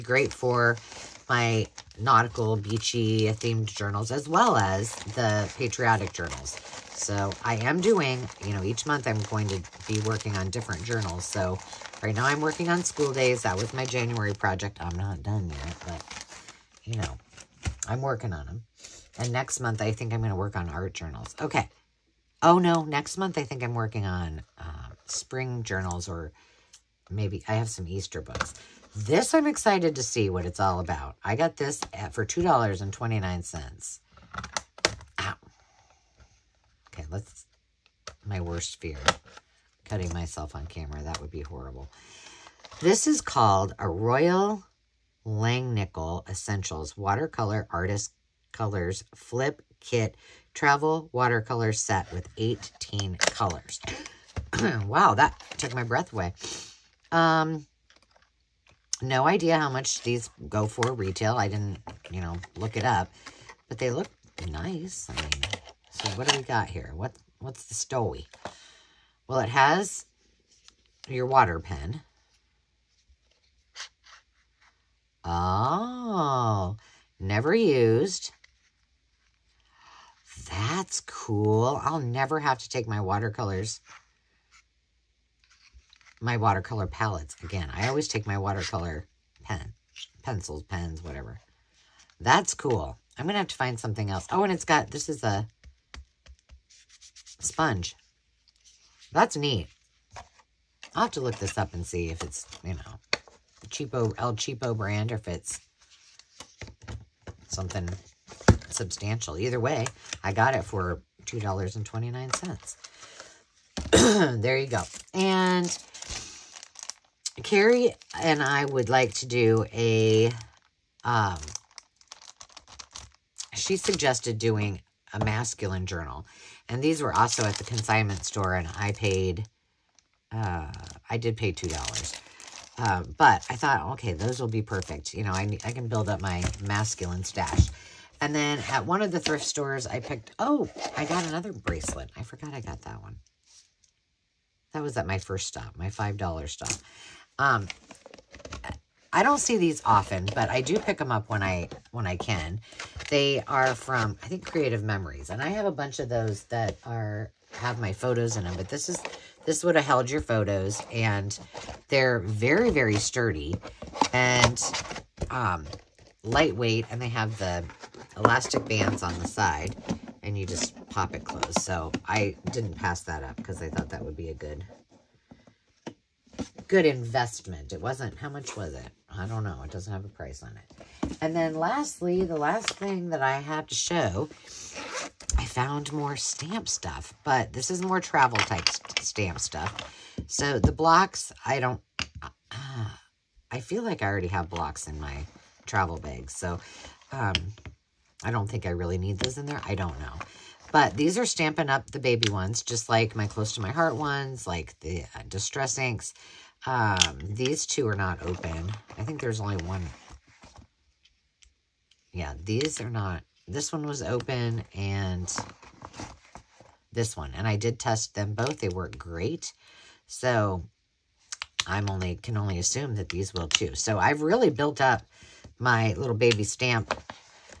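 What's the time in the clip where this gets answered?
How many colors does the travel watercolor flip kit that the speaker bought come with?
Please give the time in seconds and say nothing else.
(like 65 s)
52 s.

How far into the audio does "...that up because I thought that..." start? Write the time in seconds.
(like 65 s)
173 s.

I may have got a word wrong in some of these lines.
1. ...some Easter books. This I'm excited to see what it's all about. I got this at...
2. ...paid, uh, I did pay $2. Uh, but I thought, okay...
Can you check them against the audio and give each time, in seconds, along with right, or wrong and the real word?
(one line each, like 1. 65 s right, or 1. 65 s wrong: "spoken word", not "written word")
1. 27 s right
2. 128 s right.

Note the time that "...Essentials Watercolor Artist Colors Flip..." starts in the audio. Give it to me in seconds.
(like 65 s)
46 s.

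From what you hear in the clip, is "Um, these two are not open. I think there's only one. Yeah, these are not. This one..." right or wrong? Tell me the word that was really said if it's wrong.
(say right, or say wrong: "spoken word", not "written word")
right.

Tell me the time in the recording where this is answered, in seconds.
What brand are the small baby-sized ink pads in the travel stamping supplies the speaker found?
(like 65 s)
201 s.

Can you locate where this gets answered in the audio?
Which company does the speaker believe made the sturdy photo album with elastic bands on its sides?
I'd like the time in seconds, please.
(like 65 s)
154 s.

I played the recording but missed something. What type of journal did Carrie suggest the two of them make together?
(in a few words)
masculine journal.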